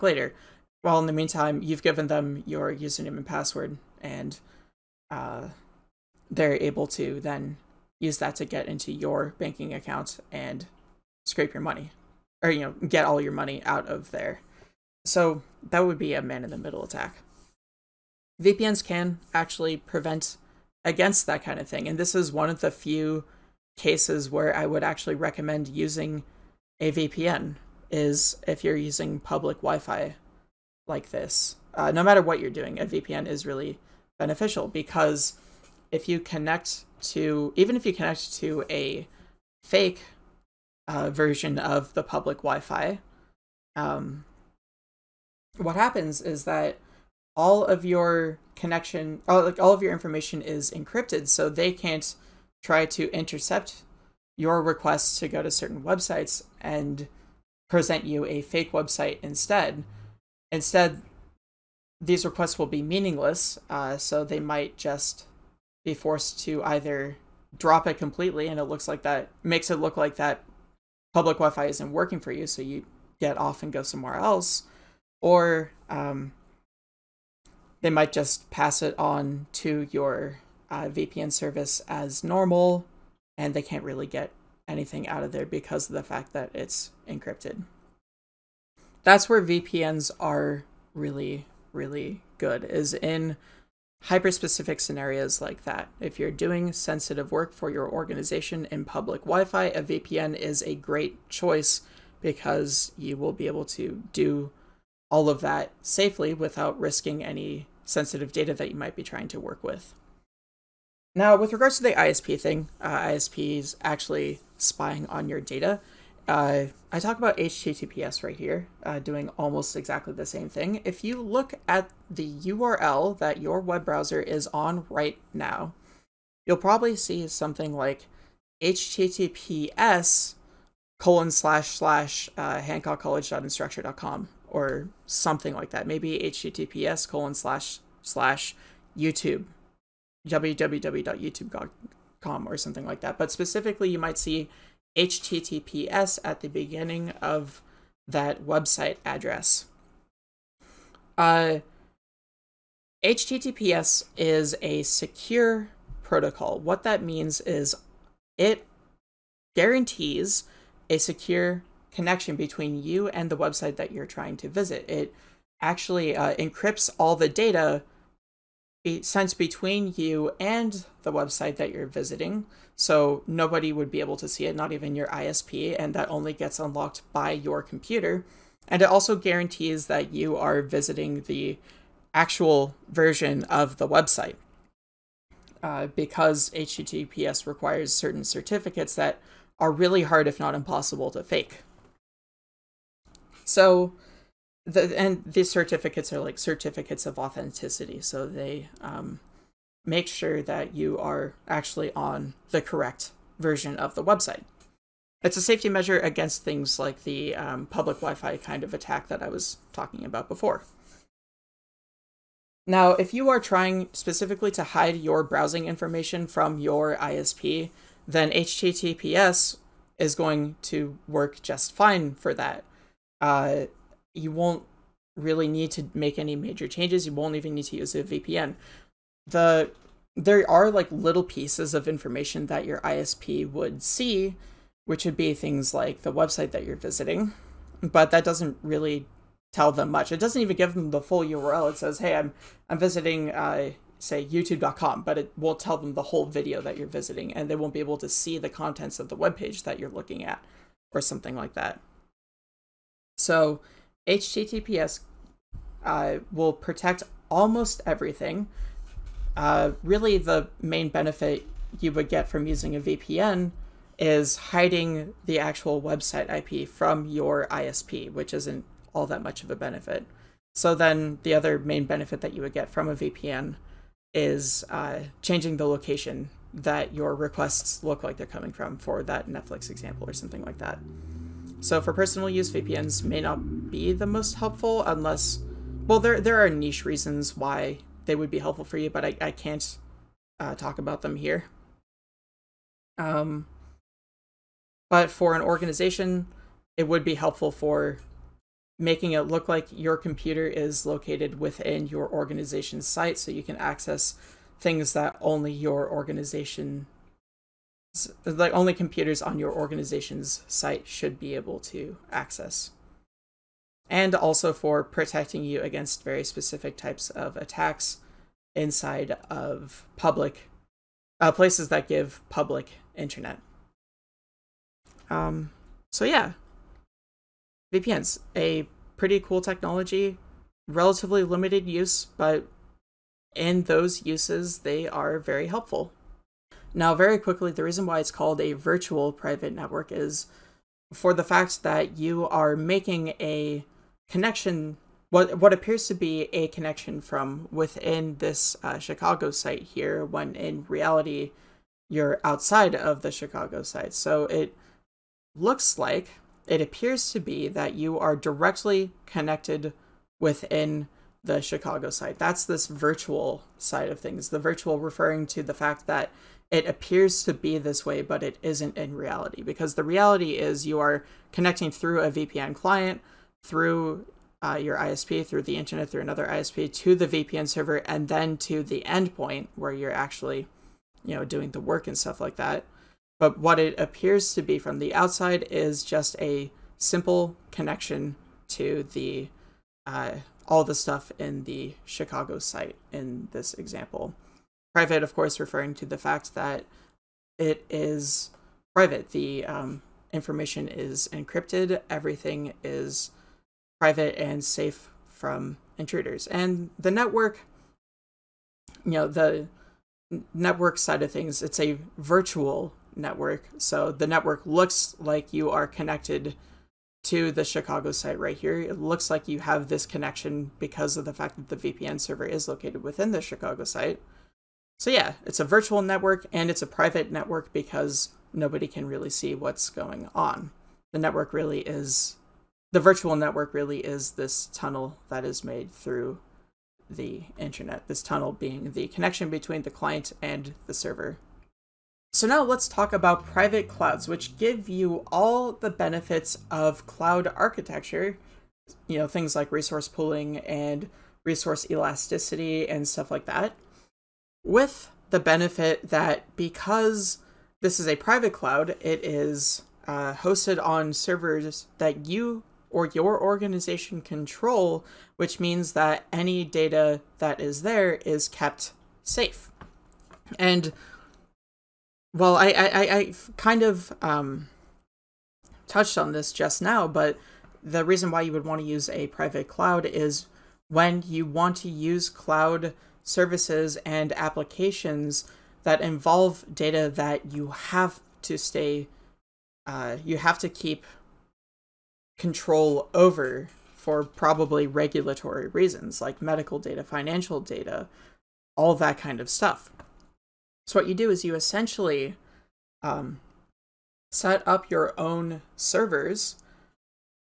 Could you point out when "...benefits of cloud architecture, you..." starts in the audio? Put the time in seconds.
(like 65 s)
445 s.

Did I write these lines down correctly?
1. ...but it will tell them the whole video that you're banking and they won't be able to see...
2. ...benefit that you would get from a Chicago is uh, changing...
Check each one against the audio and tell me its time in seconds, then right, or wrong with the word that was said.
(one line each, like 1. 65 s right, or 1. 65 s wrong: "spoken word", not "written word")
1. 245 s wrong: "visiting", not "banking"
2. 271 s wrong: "VPN", not "Chicago".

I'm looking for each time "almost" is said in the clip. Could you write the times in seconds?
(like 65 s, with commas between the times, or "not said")
119 s, 257 s.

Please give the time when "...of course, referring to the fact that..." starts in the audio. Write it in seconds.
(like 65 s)
395 s.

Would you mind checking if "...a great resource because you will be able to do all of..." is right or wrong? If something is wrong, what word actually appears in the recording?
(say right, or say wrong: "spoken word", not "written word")
wrong: "choice", not "resource".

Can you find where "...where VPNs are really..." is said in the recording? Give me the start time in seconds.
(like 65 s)
89 s.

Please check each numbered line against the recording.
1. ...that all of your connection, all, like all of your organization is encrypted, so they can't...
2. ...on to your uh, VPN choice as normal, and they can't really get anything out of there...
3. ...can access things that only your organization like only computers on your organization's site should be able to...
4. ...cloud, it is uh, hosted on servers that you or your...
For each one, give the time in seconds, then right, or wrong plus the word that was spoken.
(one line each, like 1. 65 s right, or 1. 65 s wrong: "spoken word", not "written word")
1. 46 s wrong: "information", not "organization"
2. 78 s wrong: "service", not "choice"
3. 303 s right
4. 458 s right.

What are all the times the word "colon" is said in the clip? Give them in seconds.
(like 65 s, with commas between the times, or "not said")
130 s, 137 s.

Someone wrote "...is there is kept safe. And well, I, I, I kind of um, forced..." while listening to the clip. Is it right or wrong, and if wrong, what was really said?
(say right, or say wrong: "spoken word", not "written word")
wrong: "touched", not "forced".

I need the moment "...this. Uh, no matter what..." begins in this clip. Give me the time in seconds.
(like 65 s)
31 s.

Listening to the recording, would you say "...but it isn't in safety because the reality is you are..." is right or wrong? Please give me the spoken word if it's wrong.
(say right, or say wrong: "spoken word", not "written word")
wrong: "reality", not "safety".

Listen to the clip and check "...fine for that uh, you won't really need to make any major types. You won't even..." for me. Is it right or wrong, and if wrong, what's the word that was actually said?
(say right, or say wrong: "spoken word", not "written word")
wrong: "changes", not "types".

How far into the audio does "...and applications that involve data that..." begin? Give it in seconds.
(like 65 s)
483 s.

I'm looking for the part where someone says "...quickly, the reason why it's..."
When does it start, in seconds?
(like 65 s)
337 s.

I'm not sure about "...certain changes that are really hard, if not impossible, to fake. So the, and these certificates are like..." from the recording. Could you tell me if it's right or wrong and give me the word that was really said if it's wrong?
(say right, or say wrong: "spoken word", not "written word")
wrong: "certificates", not "changes".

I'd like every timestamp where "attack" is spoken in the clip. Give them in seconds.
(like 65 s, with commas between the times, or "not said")
16 s, 208 s, 317 s.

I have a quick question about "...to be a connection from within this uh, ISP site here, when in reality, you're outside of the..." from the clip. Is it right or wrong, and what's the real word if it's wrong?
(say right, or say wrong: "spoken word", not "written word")
wrong: "Chicago", not "ISP".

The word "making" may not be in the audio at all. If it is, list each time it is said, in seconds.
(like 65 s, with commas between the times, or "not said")
298 s, 342 s.